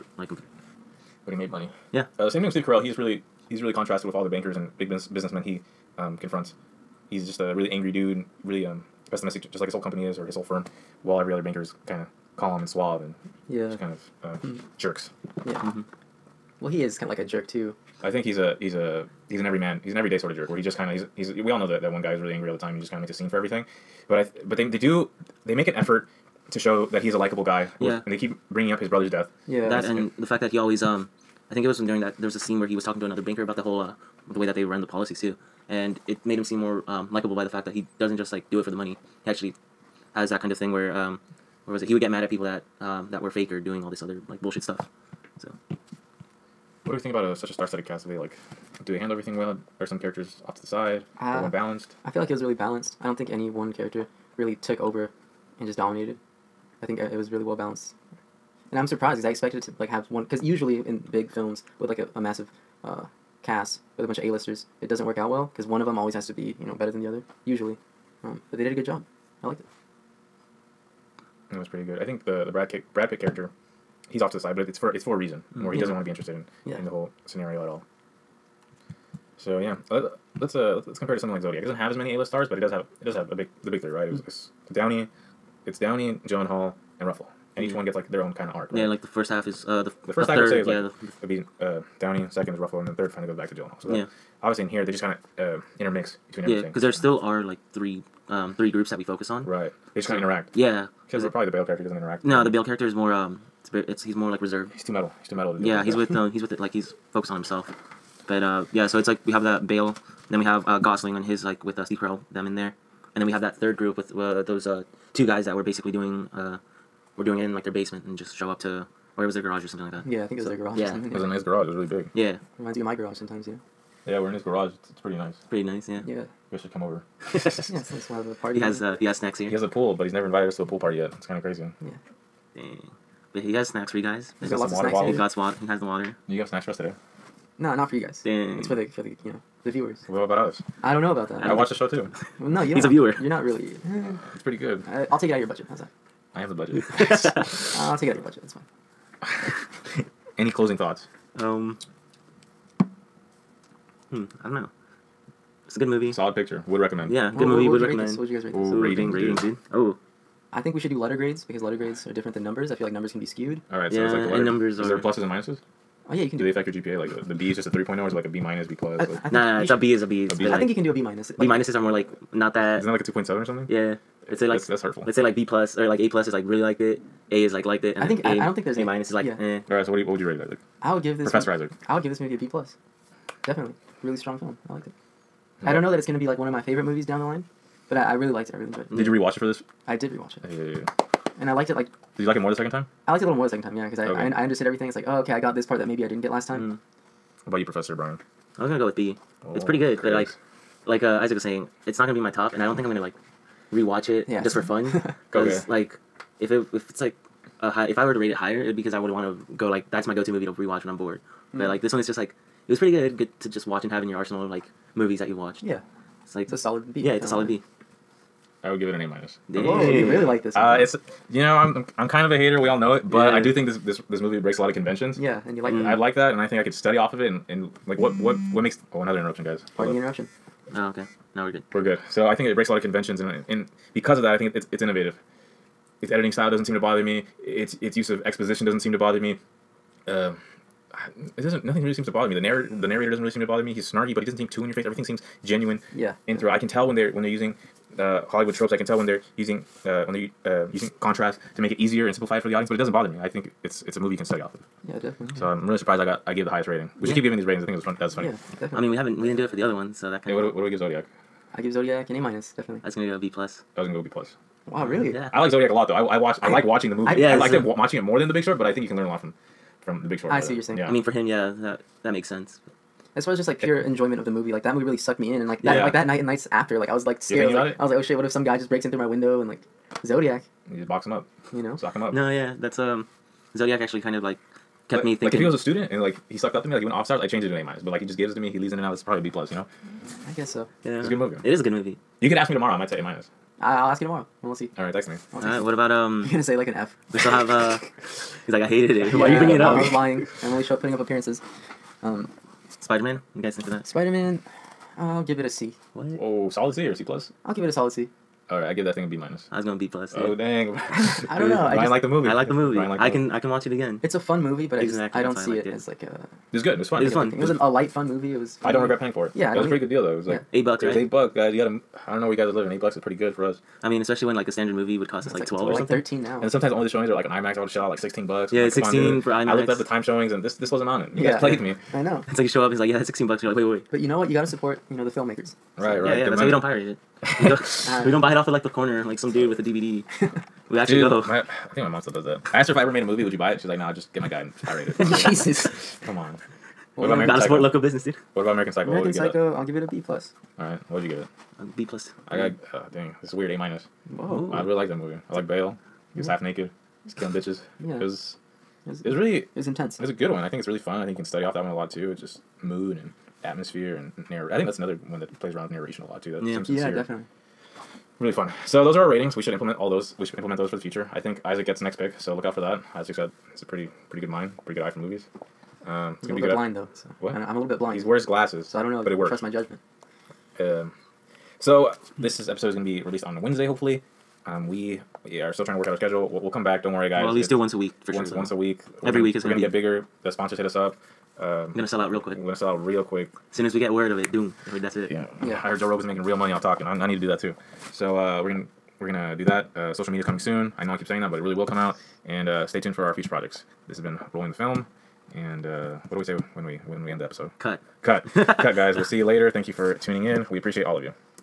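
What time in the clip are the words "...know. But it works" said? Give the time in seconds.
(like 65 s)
378 s.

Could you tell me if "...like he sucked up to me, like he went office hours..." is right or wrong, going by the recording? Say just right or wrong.
right.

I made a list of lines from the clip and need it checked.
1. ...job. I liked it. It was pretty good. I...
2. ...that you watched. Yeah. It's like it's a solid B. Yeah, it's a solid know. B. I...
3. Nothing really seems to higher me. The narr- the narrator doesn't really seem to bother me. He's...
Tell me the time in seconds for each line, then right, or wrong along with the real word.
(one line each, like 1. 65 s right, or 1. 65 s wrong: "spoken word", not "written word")
1. 68 s right
2. 215 s right
3. 241 s wrong: "bother", not "higher".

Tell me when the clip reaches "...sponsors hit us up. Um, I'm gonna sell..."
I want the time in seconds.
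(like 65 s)
390 s.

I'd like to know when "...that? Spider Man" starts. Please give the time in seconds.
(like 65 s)
303 s.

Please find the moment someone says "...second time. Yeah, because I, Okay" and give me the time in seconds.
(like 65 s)
193 s.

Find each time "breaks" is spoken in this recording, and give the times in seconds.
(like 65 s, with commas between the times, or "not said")
224 s, 232 s, 278 s.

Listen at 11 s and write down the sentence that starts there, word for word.
While every other banker is kind of calm and suave and yeah, kind of uh, mm-hmm.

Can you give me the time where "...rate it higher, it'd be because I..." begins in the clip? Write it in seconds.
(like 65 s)
208 s.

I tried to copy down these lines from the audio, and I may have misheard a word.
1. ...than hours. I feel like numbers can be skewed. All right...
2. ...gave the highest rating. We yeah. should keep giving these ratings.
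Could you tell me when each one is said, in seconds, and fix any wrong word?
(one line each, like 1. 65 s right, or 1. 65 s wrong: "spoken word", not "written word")
1. 162 s wrong: "numbers", not "hours"
2. 256 s right.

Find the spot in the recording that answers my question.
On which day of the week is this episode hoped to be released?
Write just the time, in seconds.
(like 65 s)
383 s.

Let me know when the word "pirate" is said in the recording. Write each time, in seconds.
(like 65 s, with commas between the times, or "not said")
336 s, 344 s.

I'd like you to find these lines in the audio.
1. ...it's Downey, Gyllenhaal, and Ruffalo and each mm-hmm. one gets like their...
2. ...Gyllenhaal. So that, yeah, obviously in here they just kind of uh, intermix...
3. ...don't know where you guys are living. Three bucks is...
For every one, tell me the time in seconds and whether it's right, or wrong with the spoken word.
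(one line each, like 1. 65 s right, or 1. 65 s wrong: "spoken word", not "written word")
1. 85 s right
2. 93 s right
3. 322 s wrong: "Eight", not "Three".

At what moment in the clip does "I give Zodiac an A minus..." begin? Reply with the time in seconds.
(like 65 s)
261 s.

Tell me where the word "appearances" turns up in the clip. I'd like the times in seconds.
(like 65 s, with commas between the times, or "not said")
300 s.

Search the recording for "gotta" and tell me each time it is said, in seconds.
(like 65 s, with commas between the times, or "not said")
334 s, 347 s.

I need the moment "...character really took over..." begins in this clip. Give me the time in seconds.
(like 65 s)
53 s.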